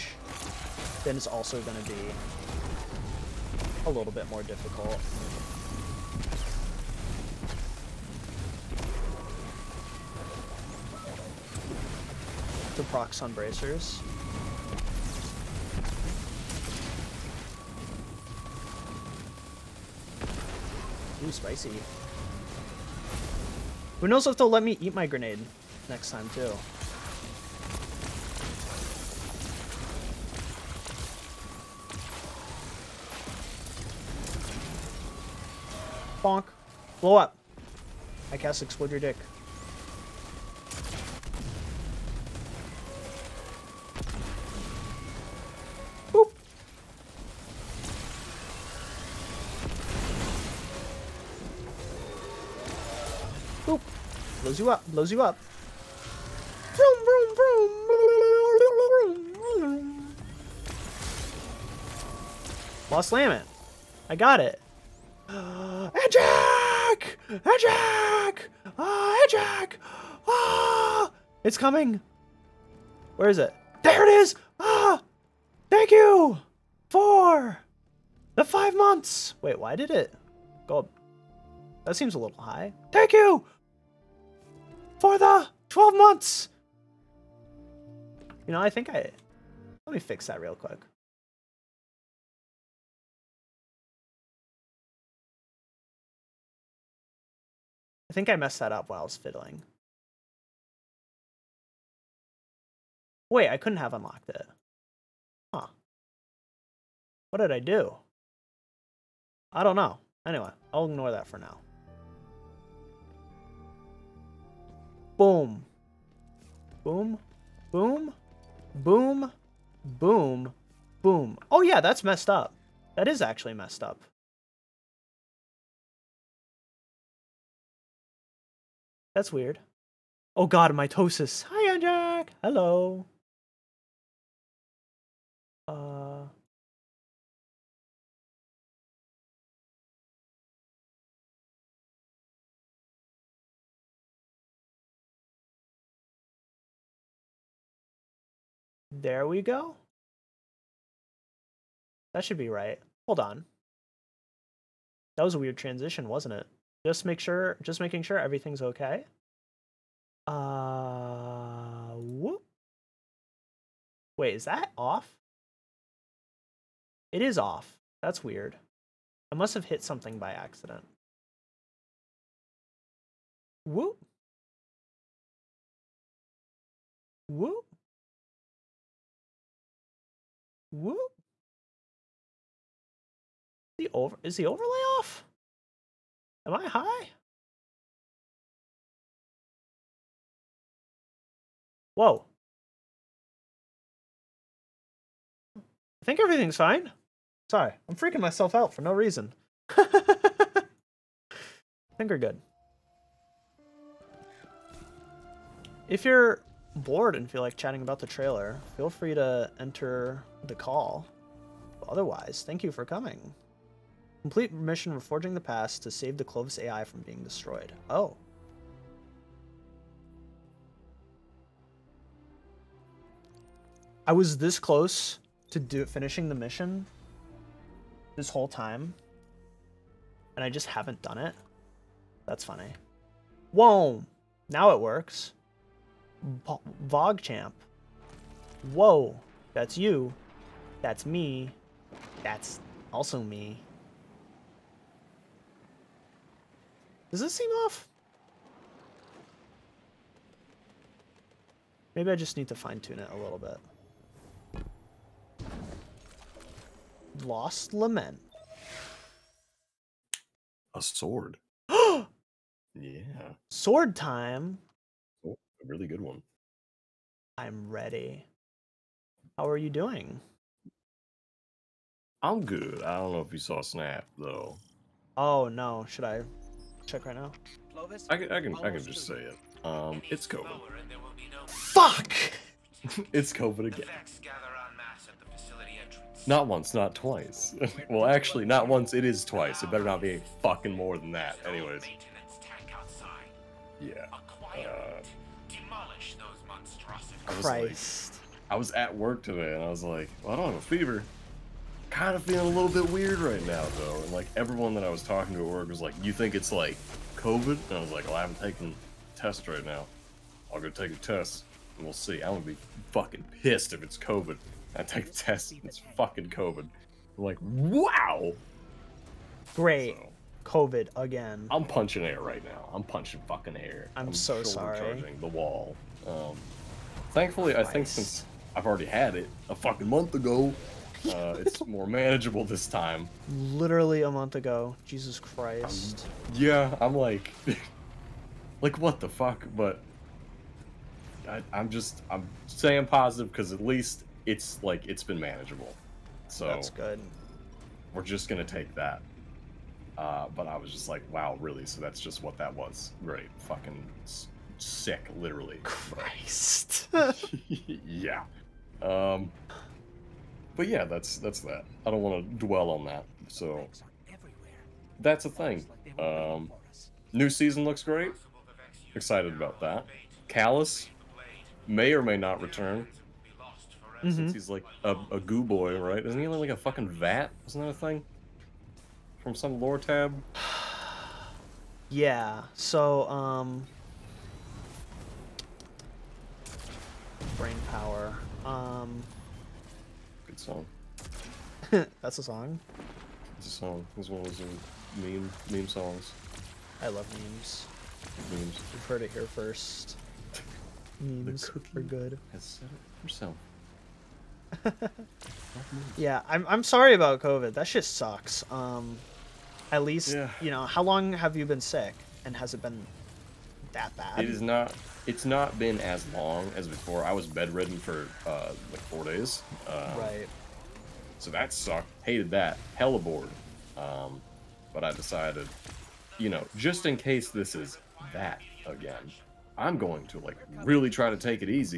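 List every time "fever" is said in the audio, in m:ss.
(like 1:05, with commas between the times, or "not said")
5:00.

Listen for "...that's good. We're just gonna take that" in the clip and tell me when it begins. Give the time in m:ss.
5:46.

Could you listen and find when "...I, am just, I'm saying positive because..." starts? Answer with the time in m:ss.
5:41.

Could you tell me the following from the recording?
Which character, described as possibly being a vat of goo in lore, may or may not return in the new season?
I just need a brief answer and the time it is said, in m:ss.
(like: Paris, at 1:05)
Calus, at 6:10.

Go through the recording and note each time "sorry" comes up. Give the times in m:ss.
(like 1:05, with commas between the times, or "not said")
3:17, 5:24, 6:46.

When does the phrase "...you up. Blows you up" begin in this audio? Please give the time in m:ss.
0:54.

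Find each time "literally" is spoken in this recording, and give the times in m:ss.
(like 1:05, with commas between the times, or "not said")
5:33, 5:55.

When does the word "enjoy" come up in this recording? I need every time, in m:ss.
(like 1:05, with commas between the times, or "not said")
not said.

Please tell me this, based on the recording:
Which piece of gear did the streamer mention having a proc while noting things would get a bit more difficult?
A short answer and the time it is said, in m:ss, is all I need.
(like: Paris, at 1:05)
Bracers, at 0:13.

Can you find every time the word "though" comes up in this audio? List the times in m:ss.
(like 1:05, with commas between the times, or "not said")
4:34, 5:03.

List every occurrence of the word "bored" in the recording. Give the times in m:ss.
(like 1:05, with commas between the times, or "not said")
3:26, 7:02.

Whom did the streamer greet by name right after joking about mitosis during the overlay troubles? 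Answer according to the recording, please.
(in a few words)
Jack.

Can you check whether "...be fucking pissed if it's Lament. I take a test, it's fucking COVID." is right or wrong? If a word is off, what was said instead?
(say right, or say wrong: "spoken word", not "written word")
wrong: "COVID", not "Lament".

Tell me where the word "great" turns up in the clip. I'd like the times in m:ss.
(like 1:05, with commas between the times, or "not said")
5:19, 5:53, 6:07.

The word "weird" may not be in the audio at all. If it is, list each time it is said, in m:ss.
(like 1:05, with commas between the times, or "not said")
2:09, 2:35, 2:48, 5:02.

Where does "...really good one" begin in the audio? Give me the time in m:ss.
4:25.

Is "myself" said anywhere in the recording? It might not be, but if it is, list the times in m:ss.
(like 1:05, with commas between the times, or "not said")
3:18.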